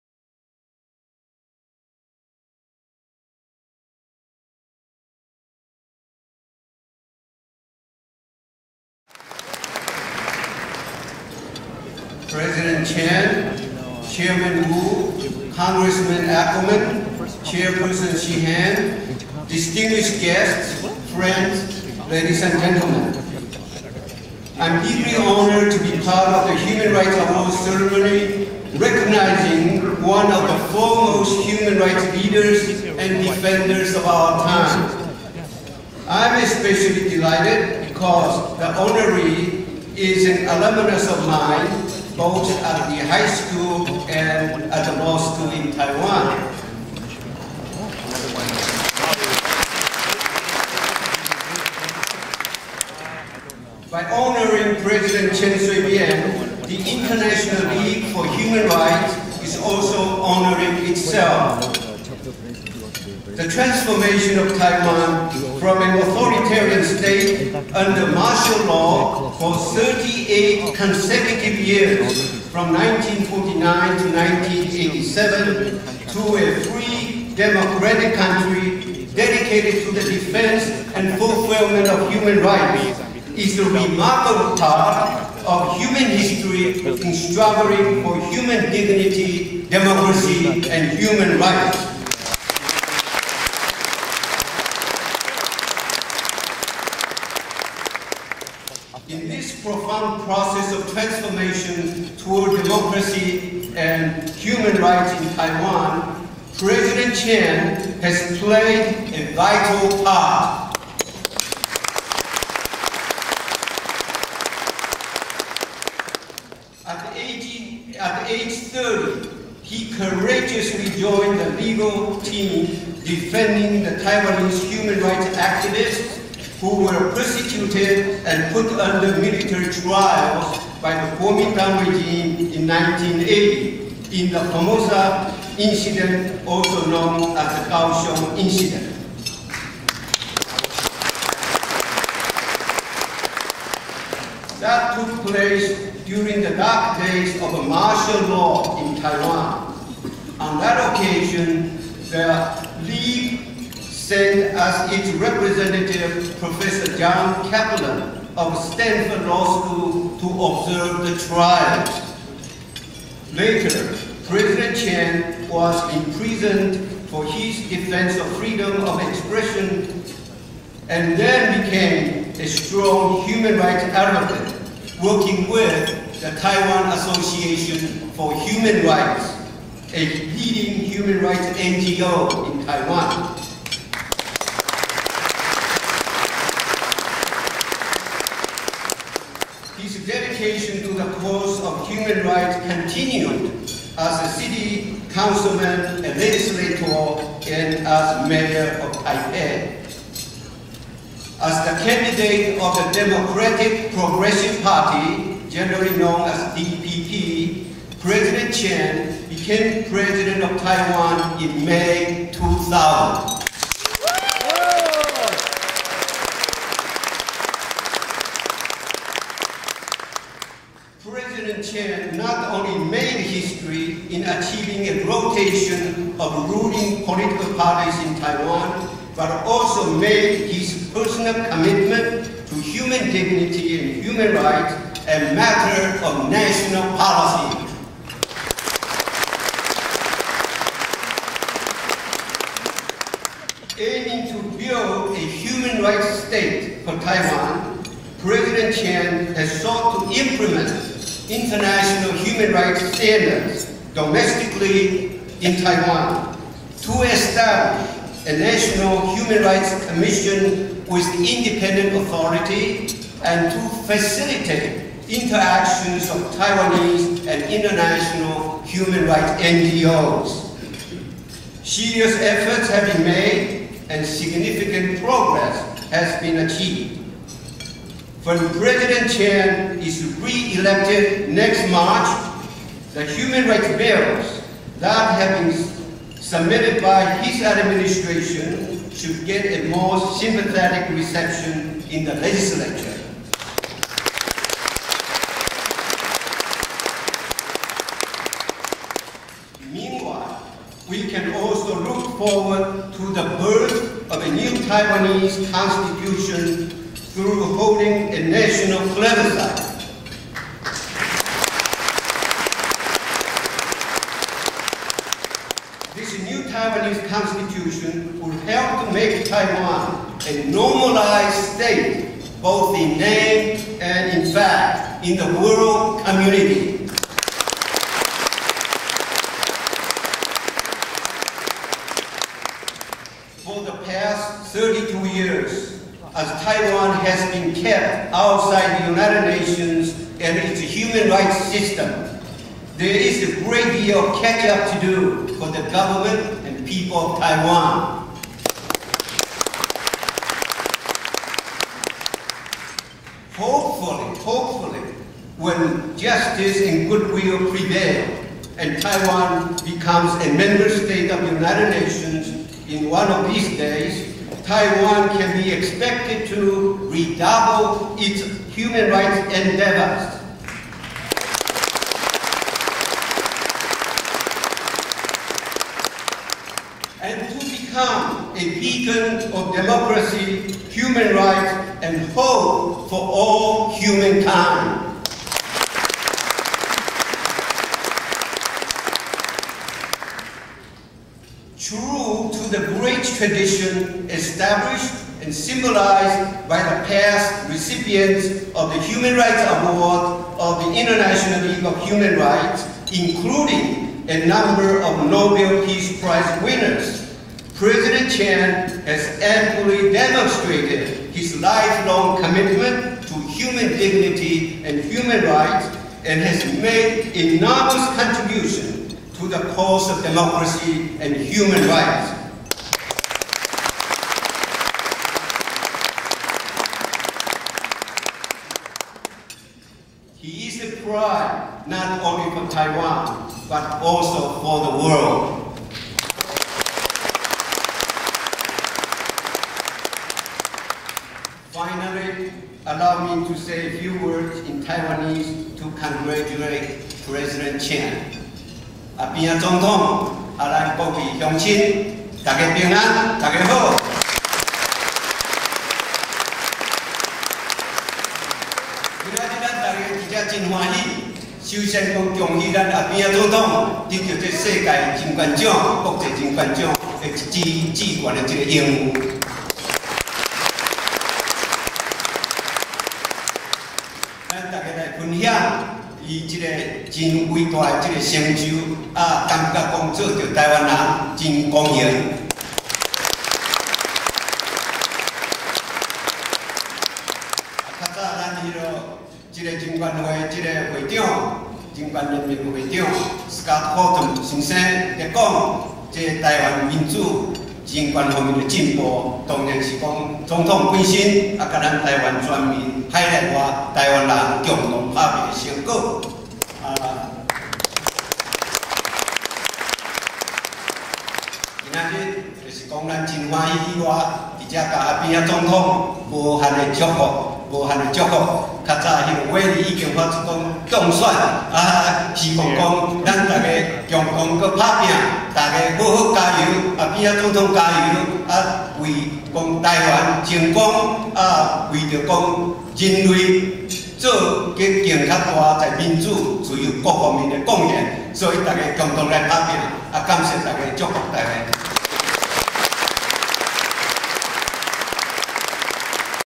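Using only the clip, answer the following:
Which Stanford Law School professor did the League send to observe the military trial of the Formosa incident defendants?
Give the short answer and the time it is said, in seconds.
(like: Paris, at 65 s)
John Kaplan, at 156 s.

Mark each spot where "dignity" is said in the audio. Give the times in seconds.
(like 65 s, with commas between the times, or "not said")
88 s, 233 s, 413 s.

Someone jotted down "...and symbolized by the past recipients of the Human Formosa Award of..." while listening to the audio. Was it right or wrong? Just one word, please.
wrong.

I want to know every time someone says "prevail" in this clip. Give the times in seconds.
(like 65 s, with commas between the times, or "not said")
357 s.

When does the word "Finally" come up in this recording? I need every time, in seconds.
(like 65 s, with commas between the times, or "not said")
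441 s.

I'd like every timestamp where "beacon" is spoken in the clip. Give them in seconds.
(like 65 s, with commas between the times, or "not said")
378 s.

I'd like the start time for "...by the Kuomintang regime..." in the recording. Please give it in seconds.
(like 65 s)
130 s.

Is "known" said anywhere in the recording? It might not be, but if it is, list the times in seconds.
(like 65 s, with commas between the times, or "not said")
136 s, 205 s.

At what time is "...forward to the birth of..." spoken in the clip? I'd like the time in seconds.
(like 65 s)
302 s.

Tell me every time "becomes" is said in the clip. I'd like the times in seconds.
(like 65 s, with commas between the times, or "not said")
359 s, 377 s.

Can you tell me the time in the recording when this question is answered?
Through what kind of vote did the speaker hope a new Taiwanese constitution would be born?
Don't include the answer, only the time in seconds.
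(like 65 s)
308 s.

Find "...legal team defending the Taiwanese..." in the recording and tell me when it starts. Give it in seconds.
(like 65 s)
121 s.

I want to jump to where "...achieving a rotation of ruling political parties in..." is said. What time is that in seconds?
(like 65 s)
224 s.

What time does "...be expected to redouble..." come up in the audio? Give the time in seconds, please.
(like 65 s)
365 s.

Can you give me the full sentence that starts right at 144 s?
That took place during the dark days of a martial law in Taiwan.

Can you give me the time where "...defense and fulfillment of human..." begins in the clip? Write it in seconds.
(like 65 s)
80 s.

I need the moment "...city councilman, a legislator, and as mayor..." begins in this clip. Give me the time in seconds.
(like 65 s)
194 s.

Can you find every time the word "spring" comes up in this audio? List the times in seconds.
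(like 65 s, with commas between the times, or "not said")
not said.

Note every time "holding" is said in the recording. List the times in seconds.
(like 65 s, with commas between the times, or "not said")
307 s.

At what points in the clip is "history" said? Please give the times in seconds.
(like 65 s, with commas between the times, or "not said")
86 s, 223 s.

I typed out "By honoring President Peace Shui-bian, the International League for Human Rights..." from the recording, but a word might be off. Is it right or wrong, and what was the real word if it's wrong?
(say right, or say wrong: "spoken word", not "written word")
wrong: "Chen", not "Peace".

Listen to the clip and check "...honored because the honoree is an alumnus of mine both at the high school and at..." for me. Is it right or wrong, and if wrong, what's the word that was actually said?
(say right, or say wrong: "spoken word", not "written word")
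wrong: "delighted", not "honored".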